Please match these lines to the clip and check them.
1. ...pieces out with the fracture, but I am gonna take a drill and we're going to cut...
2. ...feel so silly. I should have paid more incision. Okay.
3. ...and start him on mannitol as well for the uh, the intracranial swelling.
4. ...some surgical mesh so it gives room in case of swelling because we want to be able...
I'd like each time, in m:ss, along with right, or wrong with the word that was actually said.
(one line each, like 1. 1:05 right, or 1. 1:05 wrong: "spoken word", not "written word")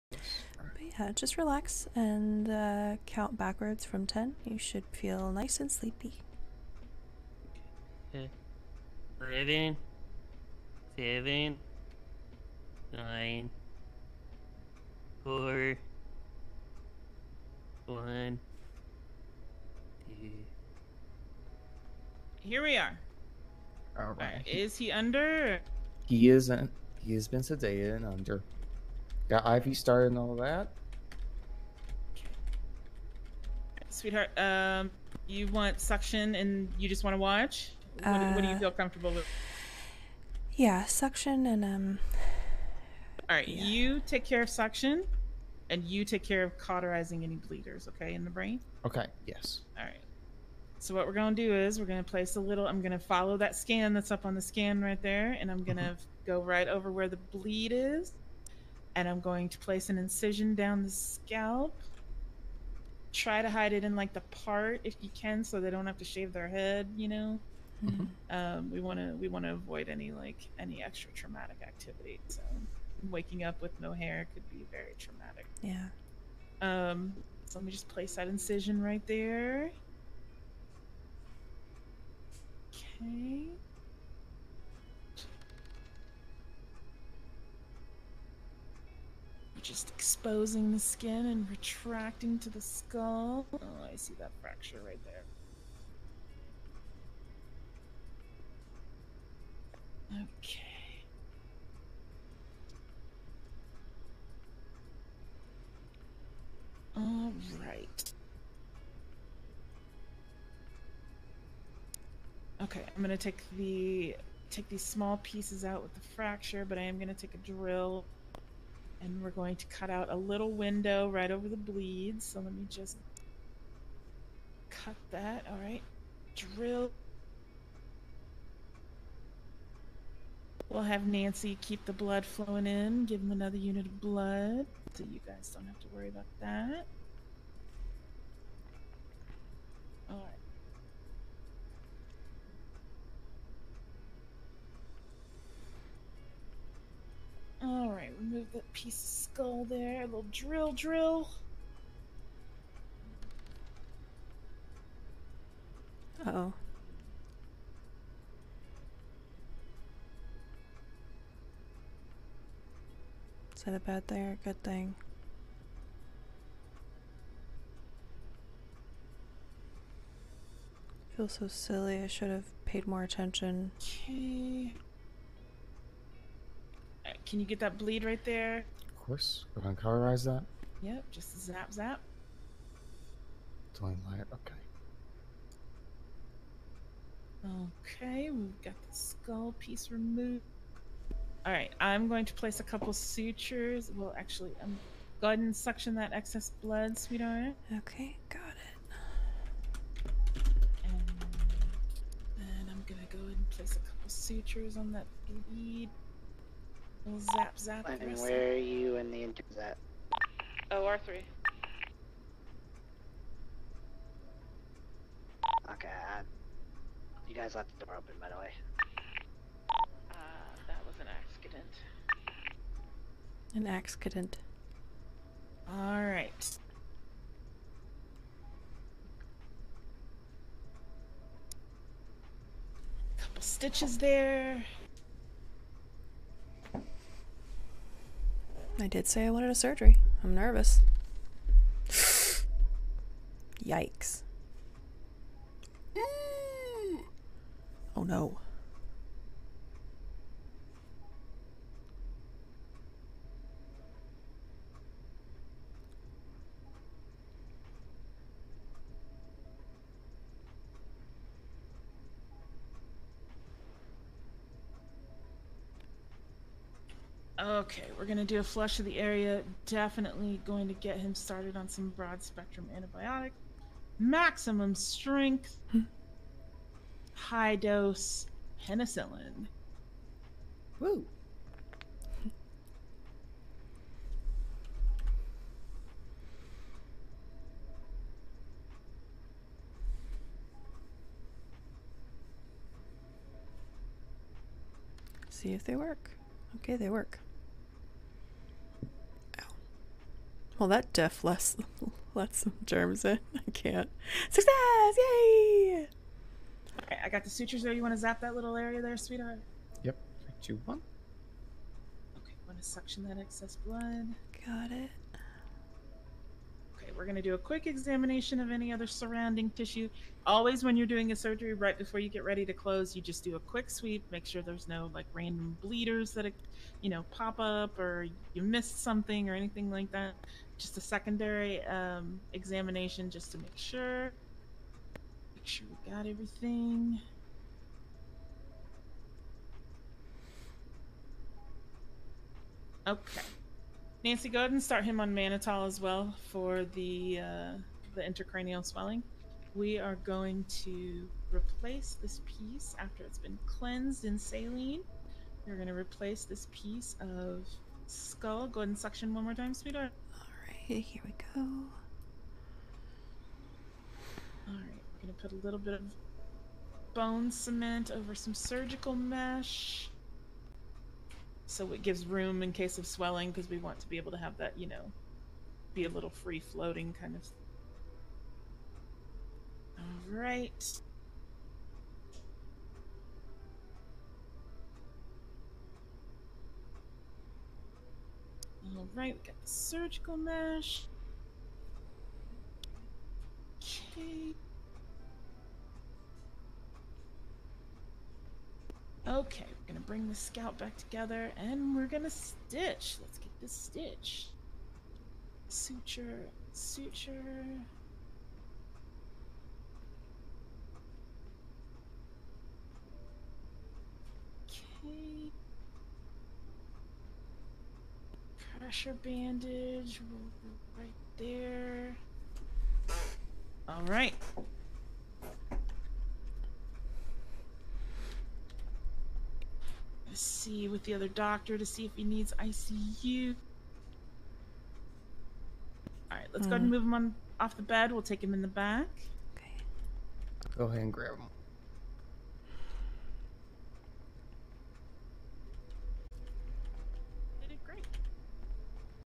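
1. 1:55 right
2. 2:51 wrong: "attention", not "incision"
3. 5:44 right
4. 6:08 right.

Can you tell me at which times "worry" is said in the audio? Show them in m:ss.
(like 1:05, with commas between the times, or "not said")
2:15.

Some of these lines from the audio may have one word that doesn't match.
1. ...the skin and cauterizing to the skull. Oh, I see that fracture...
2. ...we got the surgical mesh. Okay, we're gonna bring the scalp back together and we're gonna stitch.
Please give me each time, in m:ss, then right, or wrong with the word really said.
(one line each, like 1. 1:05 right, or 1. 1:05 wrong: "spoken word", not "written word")
1. 1:30 wrong: "retracting", not "cauterizing"
2. 6:29 right.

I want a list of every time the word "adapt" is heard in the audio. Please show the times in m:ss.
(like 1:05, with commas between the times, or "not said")
not said.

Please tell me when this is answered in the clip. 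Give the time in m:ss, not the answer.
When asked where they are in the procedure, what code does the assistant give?
3:30.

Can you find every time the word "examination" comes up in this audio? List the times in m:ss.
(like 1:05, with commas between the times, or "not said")
5:17, 5:32.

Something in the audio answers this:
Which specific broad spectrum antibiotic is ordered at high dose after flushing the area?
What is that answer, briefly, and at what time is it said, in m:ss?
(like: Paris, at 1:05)
Penicillin, at 4:38.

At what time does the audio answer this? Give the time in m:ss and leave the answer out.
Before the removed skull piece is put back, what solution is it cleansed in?
5:54.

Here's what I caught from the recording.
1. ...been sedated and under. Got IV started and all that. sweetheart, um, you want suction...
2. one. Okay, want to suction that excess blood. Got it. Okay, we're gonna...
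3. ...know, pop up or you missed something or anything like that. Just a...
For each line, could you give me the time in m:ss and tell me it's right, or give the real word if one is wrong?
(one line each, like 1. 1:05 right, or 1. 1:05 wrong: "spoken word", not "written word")
1. 0:27 right
2. 5:10 right
3. 5:26 right.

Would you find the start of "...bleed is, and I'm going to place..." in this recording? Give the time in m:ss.
0:57.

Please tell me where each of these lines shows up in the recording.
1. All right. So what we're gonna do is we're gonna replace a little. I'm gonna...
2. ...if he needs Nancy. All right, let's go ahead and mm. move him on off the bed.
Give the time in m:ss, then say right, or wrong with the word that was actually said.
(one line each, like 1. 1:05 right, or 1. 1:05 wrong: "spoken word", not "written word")
1. 0:49 wrong: "place", not "replace"
2. 7:11 wrong: "ICU", not "Nancy".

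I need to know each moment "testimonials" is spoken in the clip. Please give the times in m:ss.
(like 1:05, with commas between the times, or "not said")
not said.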